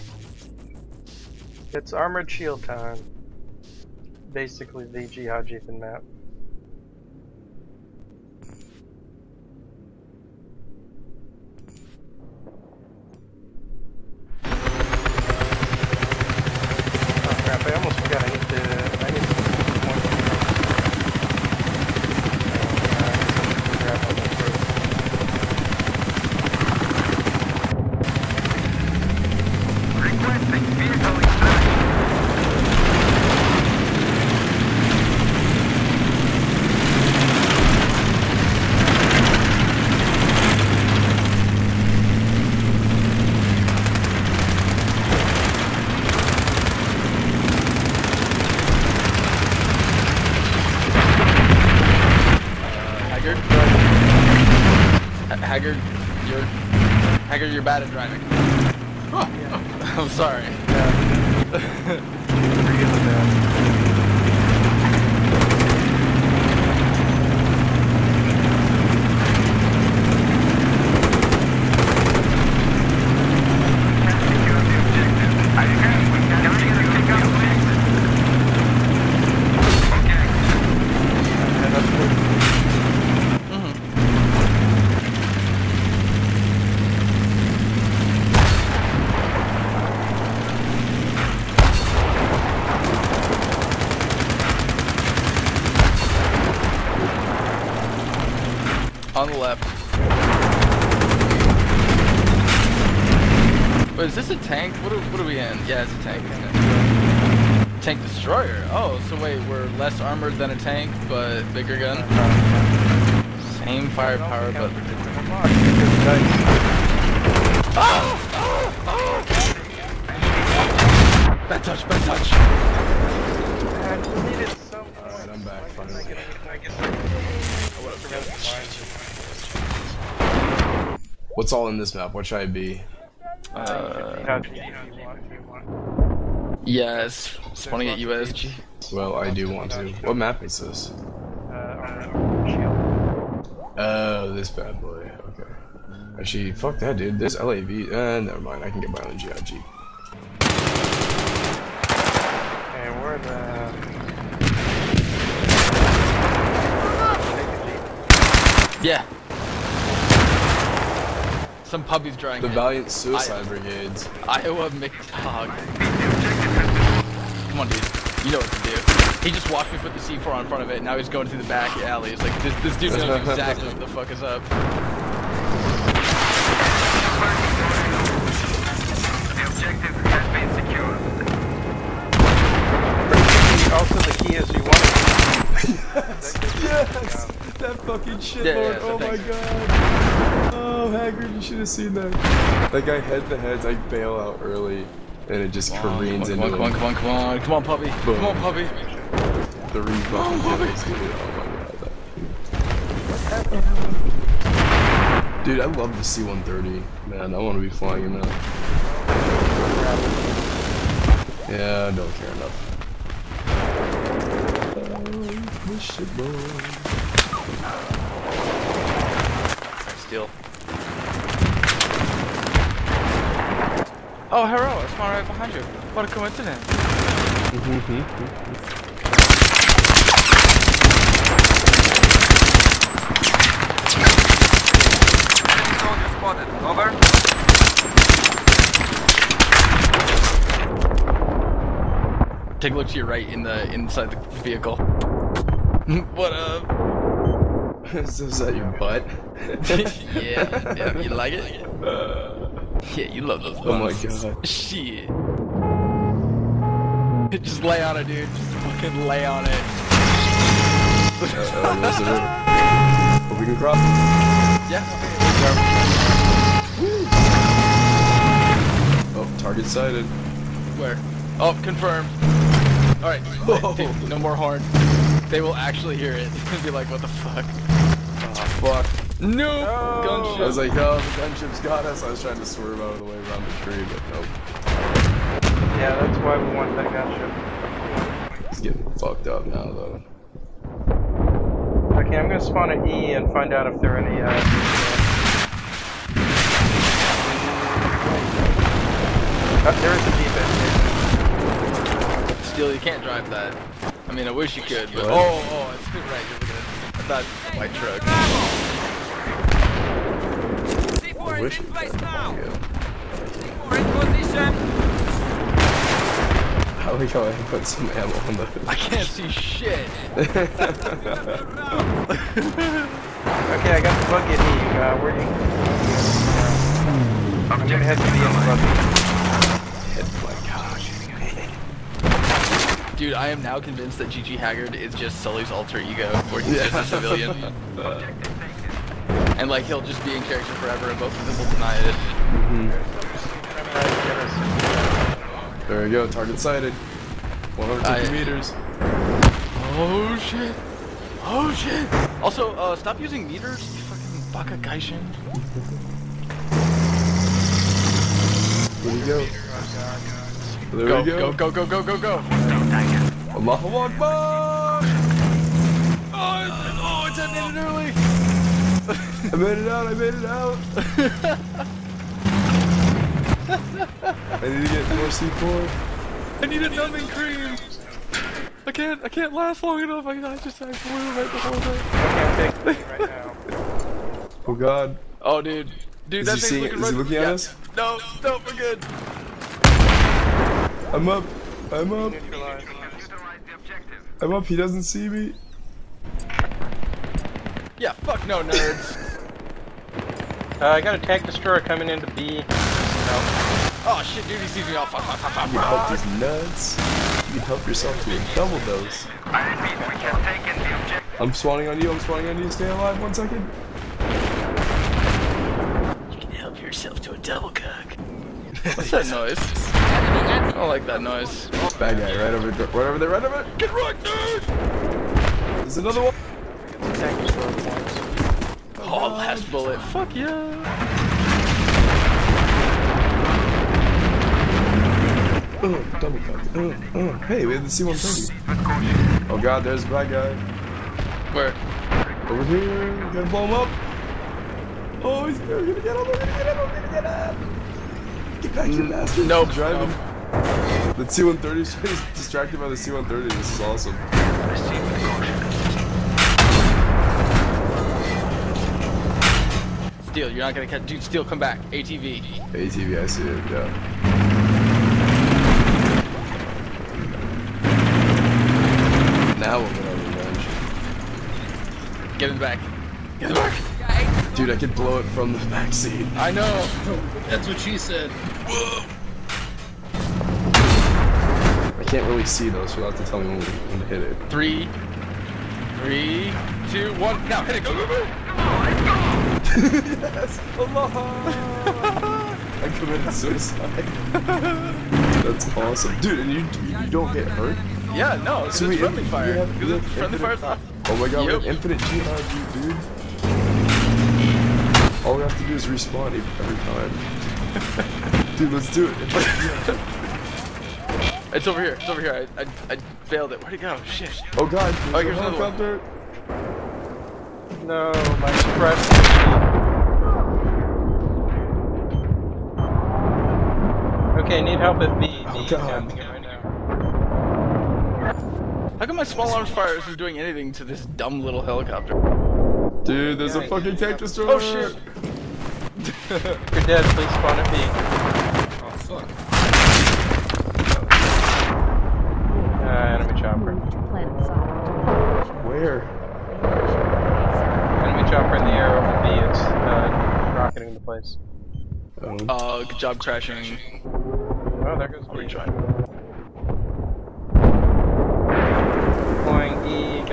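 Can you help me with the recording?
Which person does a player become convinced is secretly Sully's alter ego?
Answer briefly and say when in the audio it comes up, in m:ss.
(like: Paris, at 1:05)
Gigi Haggard, at 5:34.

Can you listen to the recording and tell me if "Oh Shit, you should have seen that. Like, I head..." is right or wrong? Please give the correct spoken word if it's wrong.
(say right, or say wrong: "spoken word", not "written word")
wrong: "Hagrid", not "Shit".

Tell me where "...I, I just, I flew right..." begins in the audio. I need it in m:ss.
6:20.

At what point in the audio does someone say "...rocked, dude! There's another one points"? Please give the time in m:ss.
7:03.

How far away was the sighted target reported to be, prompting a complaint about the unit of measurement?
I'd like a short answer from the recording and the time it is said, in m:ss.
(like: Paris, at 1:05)
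150 meters, at 5:47.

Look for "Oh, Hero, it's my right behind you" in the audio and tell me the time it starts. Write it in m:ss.
3:44.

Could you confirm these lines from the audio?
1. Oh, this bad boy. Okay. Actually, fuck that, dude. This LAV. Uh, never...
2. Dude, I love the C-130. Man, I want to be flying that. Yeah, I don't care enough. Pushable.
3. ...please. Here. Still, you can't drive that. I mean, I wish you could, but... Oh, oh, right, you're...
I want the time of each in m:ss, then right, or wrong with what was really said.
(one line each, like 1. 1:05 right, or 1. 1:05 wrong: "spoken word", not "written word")
1. 2:23 right
2. 3:25 right
3. 5:01 wrong: "defense", not "please".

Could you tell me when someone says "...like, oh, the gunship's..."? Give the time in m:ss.
4:40.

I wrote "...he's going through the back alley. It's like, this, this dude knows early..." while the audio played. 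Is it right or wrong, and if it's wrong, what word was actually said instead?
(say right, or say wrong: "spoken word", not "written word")
wrong: "exactly", not "early".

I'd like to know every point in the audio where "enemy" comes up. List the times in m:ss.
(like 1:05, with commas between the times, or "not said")
9:03, 9:07.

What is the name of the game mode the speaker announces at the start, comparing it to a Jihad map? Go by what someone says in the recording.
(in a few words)
Armored Shield.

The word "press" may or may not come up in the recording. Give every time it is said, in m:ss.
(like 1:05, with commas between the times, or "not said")
8:38.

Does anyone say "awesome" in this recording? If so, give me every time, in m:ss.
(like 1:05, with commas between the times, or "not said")
7:33, 8:15.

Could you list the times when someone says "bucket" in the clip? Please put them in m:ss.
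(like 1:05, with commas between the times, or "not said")
5:24, 5:29.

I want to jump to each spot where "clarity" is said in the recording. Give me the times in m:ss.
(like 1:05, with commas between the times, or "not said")
not said.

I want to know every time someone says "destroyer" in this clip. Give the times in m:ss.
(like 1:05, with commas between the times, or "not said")
1:48, 6:41, 8:53.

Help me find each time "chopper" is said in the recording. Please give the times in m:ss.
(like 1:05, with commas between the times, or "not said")
9:03, 9:08.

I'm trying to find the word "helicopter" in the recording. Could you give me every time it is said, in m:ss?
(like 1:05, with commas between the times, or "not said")
8:35, 8:51.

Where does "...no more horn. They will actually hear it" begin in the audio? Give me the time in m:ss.
4:34.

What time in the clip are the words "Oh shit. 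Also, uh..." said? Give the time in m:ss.
5:51.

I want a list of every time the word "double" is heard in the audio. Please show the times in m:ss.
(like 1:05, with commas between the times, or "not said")
6:48, 6:57.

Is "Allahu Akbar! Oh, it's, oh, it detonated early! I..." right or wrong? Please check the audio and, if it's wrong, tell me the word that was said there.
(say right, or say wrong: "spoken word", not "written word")
right.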